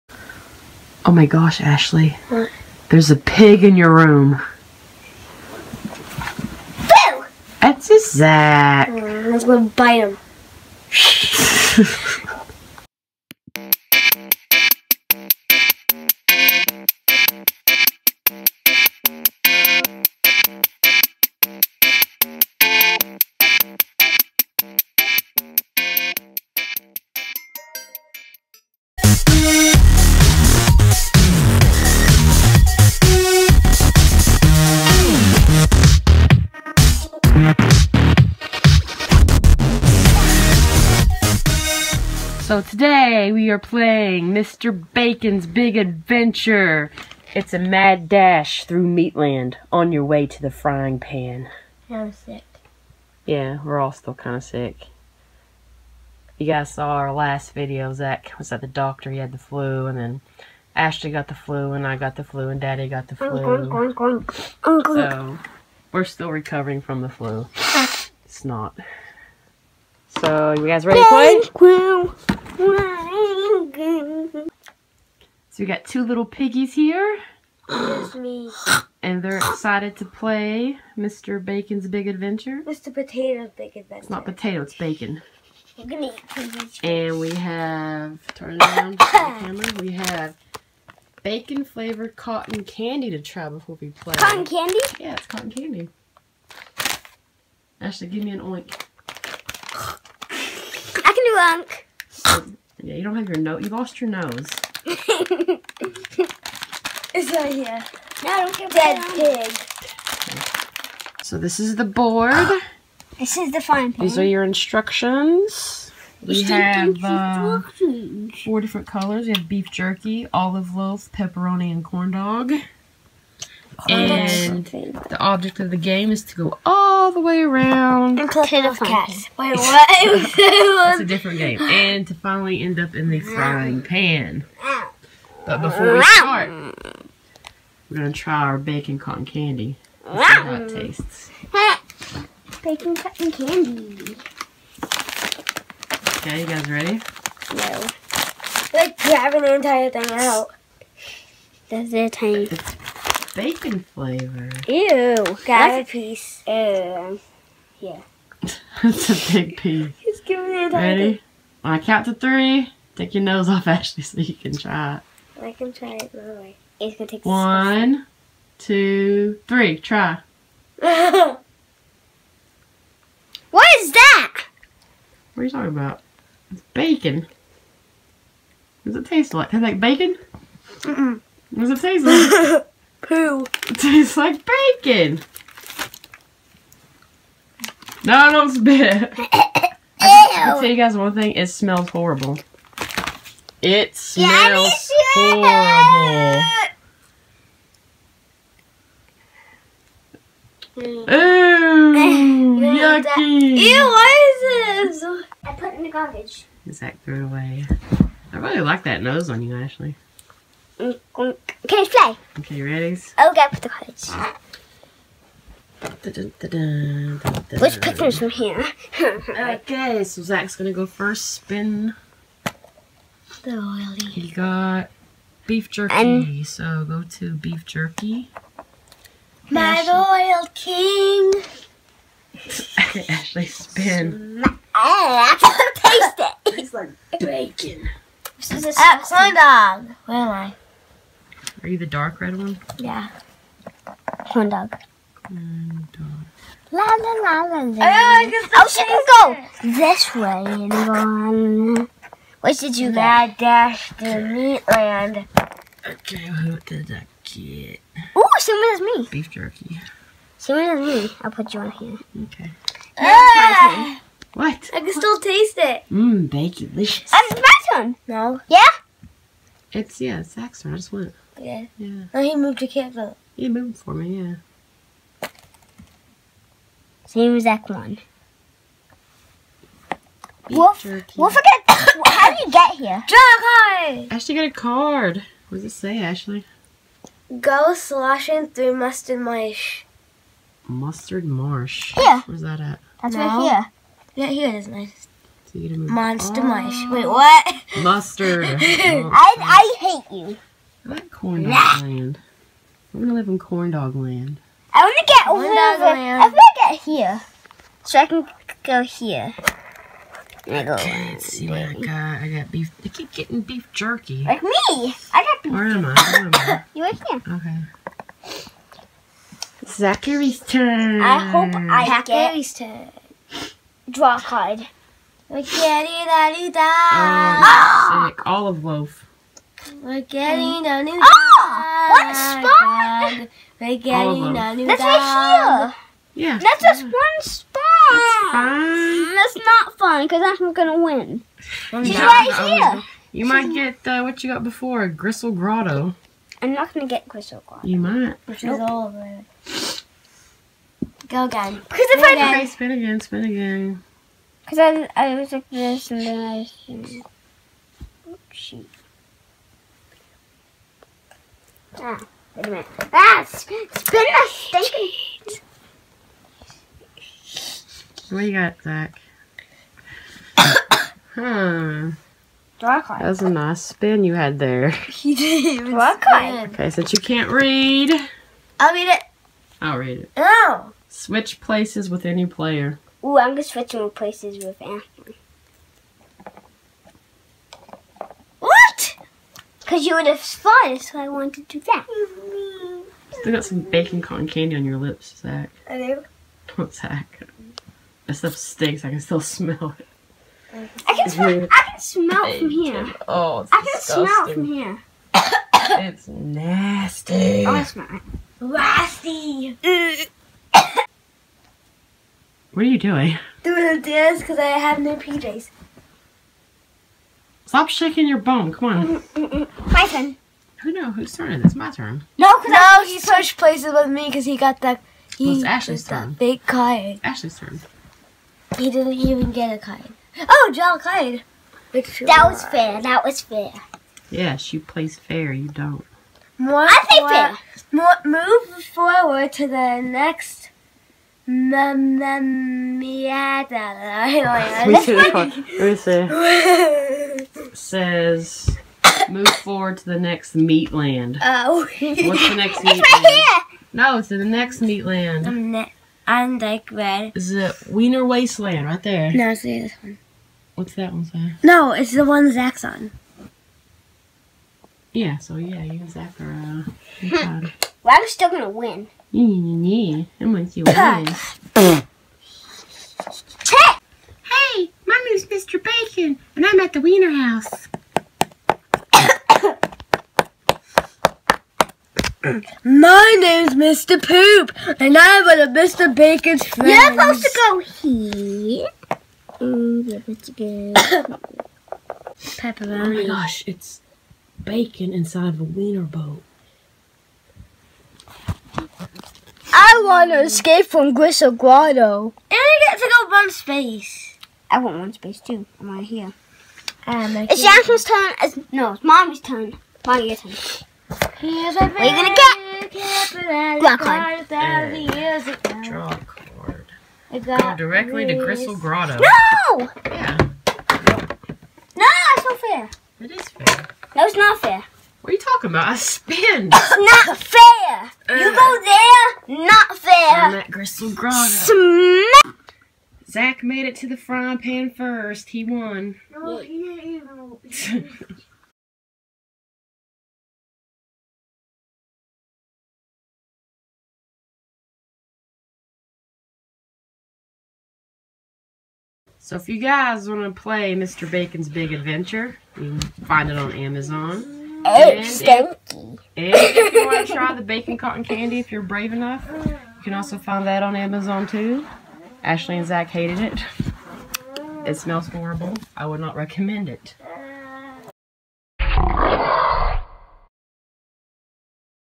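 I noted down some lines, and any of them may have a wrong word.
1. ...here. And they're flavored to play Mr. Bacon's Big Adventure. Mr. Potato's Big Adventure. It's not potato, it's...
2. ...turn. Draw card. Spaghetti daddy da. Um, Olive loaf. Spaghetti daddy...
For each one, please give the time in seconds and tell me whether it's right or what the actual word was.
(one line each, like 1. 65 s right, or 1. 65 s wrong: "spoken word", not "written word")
1. 76 s wrong: "excited", not "flavored"
2. 322 s right.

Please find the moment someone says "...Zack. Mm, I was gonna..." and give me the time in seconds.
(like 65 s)
8 s.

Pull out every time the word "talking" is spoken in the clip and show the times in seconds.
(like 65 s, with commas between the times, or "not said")
175 s, 525 s.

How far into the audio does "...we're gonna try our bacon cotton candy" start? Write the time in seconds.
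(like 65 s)
137 s.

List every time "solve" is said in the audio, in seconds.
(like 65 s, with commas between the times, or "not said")
not said.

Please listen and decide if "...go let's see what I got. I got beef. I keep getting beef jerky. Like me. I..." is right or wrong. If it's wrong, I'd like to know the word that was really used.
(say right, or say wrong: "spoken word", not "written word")
right.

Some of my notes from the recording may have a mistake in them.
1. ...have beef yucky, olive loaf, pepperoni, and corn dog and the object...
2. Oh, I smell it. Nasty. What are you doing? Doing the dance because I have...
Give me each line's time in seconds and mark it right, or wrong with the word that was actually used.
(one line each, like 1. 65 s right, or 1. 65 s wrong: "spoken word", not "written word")
1. 119 s wrong: "jerky", not "yucky"
2. 407 s right.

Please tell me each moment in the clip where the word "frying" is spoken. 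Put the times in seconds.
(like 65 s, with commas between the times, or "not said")
50 s, 133 s, 533 s.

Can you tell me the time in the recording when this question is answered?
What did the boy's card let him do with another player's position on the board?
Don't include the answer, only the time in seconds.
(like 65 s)
380 s.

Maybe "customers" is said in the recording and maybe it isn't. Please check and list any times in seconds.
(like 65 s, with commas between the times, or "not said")
not said.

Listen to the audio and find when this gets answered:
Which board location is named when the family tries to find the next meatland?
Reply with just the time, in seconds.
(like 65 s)
457 s.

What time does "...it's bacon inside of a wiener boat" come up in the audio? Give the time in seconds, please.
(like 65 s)
493 s.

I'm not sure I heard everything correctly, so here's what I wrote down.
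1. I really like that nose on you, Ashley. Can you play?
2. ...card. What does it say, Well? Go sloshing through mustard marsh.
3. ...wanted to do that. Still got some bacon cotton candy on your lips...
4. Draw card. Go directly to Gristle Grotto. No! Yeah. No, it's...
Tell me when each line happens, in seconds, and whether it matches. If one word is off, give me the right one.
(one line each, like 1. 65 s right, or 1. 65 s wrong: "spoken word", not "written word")
1. 208 s right
2. 284 s wrong: "Ashley", not "Well"
3. 391 s right
4. 514 s right.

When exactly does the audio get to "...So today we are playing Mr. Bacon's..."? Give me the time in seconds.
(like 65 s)
42 s.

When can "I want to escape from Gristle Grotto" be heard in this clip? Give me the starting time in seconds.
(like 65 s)
499 s.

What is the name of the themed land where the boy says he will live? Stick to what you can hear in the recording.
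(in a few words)
Corn dog land.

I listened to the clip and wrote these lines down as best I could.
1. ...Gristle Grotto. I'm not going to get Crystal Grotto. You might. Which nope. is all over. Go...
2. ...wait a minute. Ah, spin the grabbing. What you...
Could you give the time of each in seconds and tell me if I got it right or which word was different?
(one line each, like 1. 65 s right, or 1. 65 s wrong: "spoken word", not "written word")
1. 344 s right
2. 362 s wrong: "stinking", not "grabbing".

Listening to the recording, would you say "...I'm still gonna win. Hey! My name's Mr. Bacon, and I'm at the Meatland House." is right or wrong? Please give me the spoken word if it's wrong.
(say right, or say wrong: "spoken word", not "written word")
wrong: "Wiener", not "Meatland".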